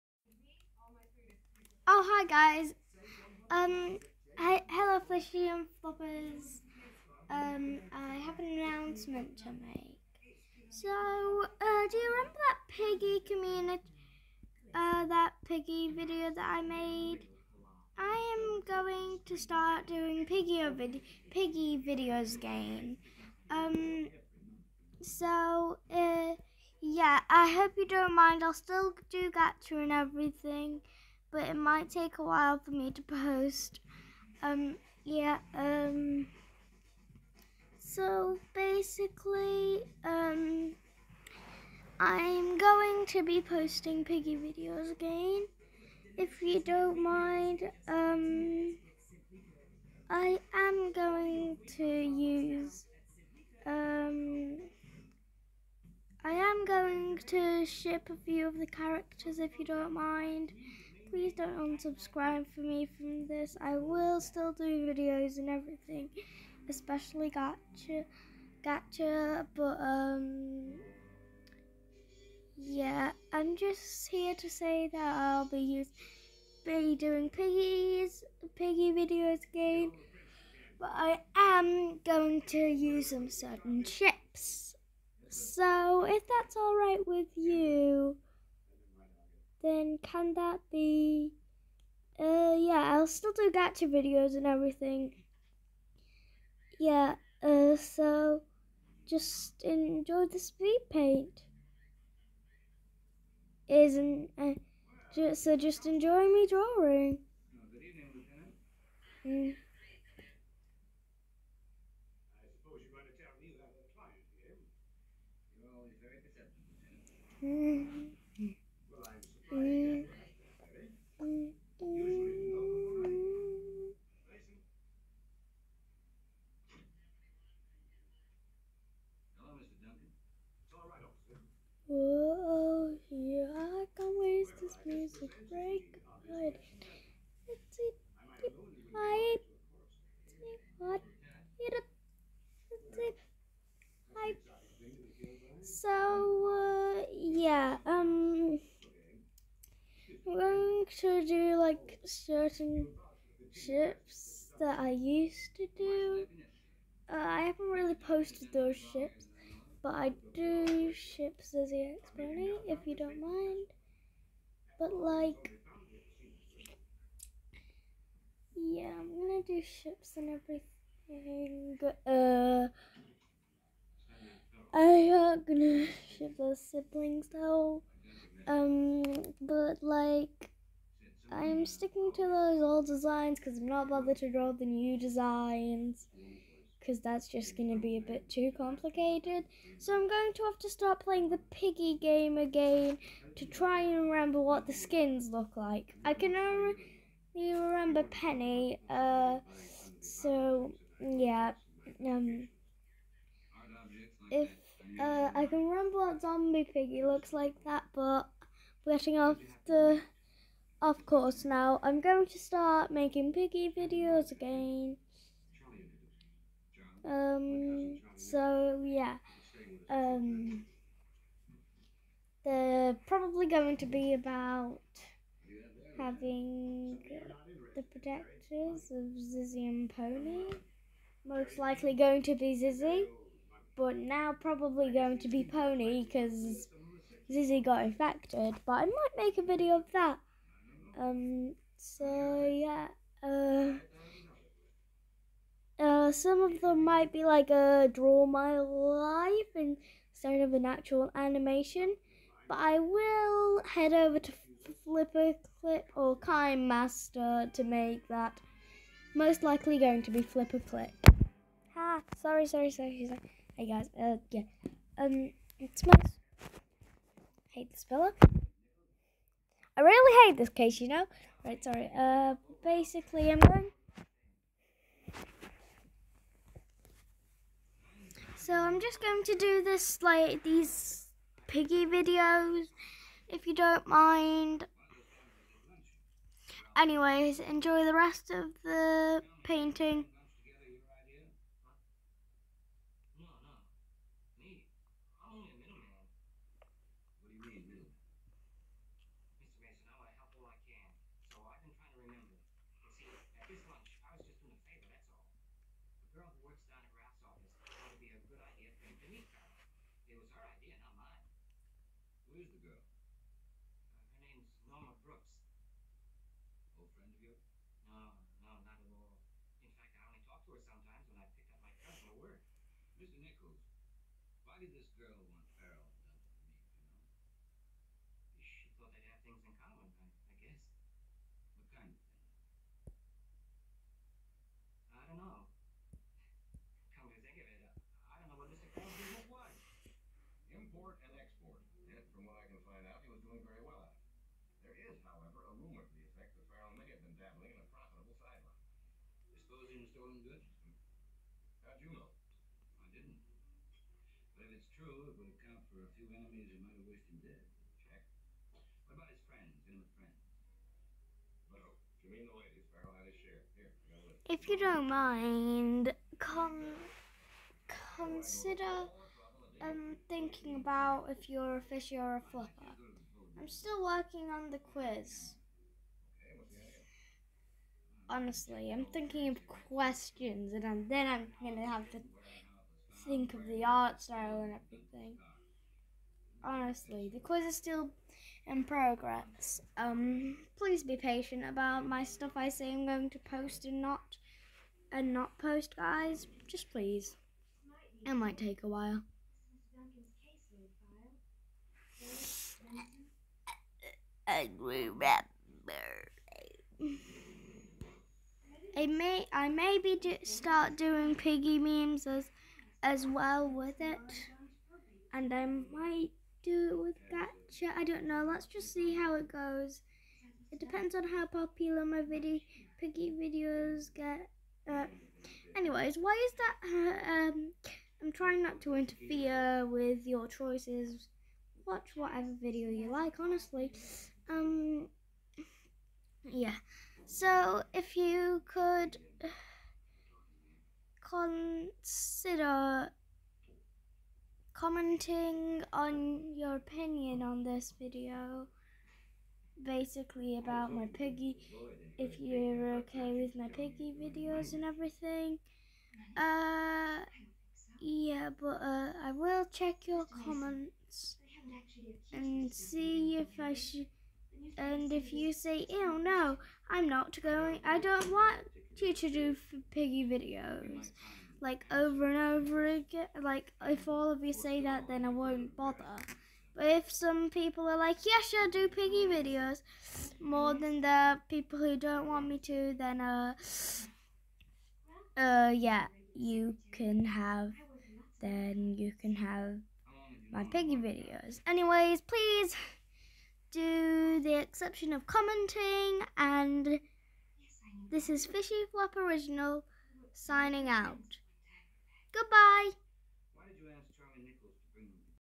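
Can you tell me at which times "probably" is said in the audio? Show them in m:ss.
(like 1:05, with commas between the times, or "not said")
3:43, 3:54.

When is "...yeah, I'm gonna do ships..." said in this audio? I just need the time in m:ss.
2:48.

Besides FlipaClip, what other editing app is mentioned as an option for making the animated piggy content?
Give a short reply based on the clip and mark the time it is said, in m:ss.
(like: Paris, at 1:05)
KineMaster, at 4:16.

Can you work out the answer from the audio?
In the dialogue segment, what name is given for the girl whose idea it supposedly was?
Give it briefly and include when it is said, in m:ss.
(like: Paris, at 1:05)
Norma Brooks, at 5:14.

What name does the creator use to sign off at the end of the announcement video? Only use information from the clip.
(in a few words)
Fishy Flop Original.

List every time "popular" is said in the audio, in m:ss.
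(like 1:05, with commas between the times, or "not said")
7:01.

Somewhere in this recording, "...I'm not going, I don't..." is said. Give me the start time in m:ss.
7:46.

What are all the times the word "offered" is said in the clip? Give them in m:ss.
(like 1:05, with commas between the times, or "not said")
not said.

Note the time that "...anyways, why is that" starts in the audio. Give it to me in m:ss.
7:05.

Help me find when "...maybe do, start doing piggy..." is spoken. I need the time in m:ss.
6:49.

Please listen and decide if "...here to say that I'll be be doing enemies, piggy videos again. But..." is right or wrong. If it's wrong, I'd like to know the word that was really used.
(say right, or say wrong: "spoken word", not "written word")
wrong: "piggies", not "enemies".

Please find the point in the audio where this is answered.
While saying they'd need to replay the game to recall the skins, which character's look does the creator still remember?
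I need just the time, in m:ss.
3:18.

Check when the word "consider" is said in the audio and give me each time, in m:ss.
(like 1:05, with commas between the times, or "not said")
6:07, 7:21.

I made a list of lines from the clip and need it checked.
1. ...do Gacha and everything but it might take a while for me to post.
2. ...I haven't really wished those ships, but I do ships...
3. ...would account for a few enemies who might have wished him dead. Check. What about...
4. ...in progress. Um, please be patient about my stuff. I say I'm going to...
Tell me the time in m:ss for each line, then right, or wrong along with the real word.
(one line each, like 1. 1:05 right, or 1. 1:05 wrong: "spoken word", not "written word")
1. 0:29 right
2. 2:37 wrong: "posted", not "wished"
3. 5:55 right
4. 6:28 right.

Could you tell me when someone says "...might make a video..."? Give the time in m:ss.
3:58.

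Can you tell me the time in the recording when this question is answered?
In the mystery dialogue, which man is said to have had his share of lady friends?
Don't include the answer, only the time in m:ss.
6:02.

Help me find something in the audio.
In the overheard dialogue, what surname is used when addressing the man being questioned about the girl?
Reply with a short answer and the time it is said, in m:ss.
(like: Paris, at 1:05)
Nichols, at 5:22.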